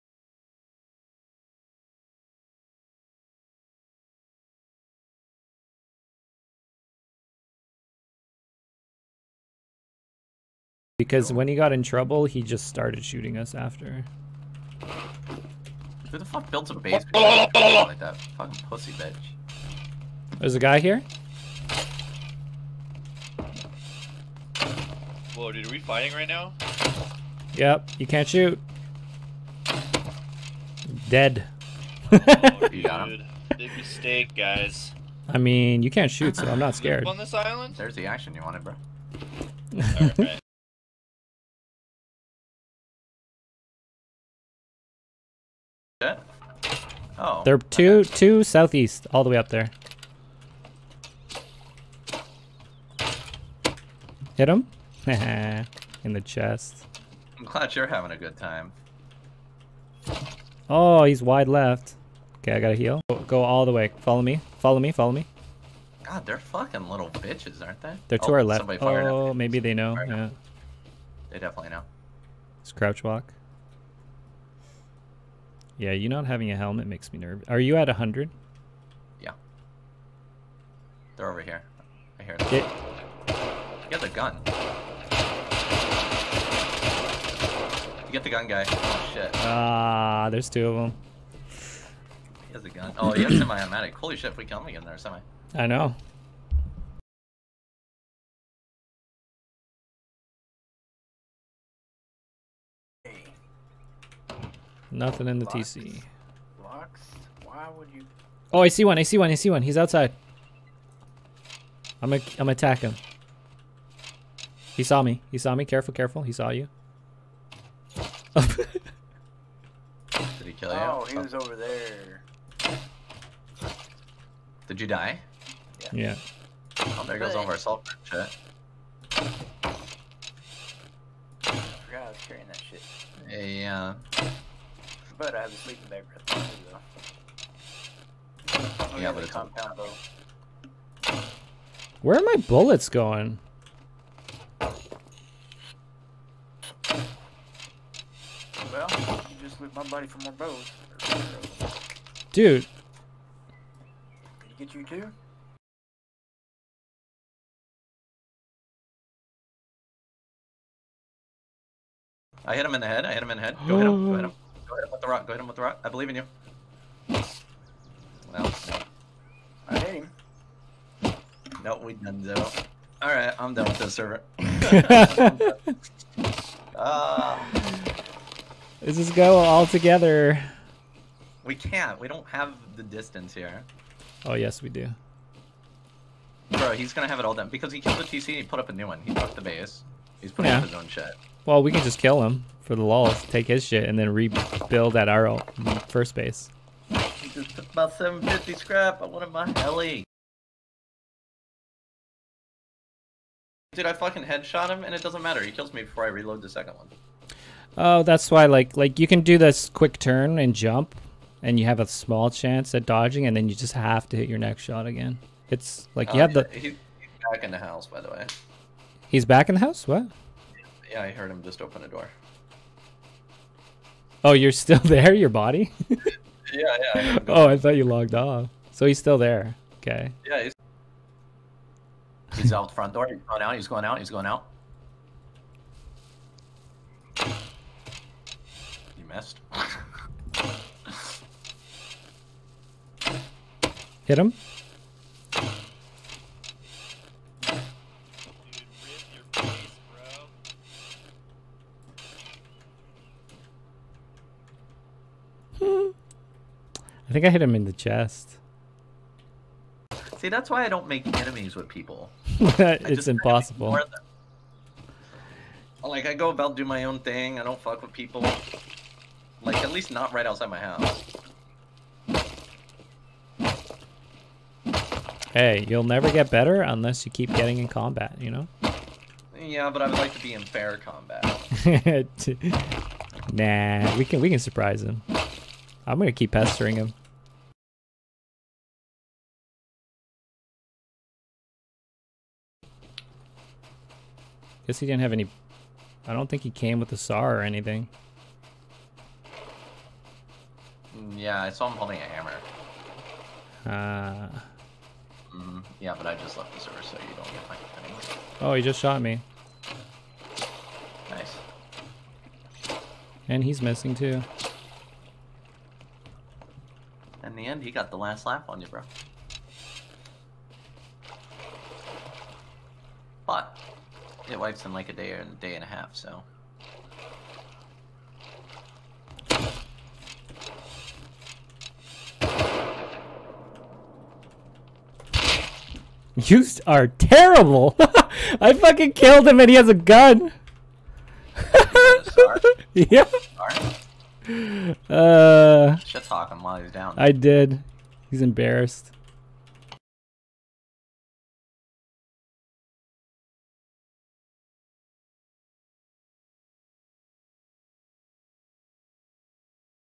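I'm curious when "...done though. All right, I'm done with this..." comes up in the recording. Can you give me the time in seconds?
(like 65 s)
171 s.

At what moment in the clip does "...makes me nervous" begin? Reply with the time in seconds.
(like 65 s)
76 s.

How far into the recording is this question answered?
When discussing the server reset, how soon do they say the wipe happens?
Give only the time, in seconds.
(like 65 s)
324 s.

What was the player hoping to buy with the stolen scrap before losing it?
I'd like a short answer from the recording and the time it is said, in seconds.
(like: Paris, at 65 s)
heli, at 199 s.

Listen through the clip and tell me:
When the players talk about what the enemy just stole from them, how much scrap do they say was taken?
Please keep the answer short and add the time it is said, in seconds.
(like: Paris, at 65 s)
750, at 197 s.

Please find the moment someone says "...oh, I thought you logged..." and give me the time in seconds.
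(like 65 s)
227 s.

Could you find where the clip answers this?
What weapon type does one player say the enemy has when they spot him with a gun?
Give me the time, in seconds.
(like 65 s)
93 s.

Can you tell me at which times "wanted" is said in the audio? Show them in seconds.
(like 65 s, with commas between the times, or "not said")
38 s, 199 s.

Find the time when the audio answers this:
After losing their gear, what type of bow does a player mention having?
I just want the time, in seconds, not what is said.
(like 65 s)
139 s.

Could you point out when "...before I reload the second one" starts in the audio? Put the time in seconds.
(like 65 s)
205 s.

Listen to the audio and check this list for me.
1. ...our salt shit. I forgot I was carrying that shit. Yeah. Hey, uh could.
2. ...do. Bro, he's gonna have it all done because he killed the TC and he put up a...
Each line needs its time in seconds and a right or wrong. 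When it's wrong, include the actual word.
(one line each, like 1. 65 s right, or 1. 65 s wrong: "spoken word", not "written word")
1. 127 s right
2. 184 s right.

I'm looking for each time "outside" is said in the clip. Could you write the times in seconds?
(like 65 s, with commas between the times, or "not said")
109 s, 270 s.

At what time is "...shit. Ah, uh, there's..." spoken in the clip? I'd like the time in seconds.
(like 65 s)
89 s.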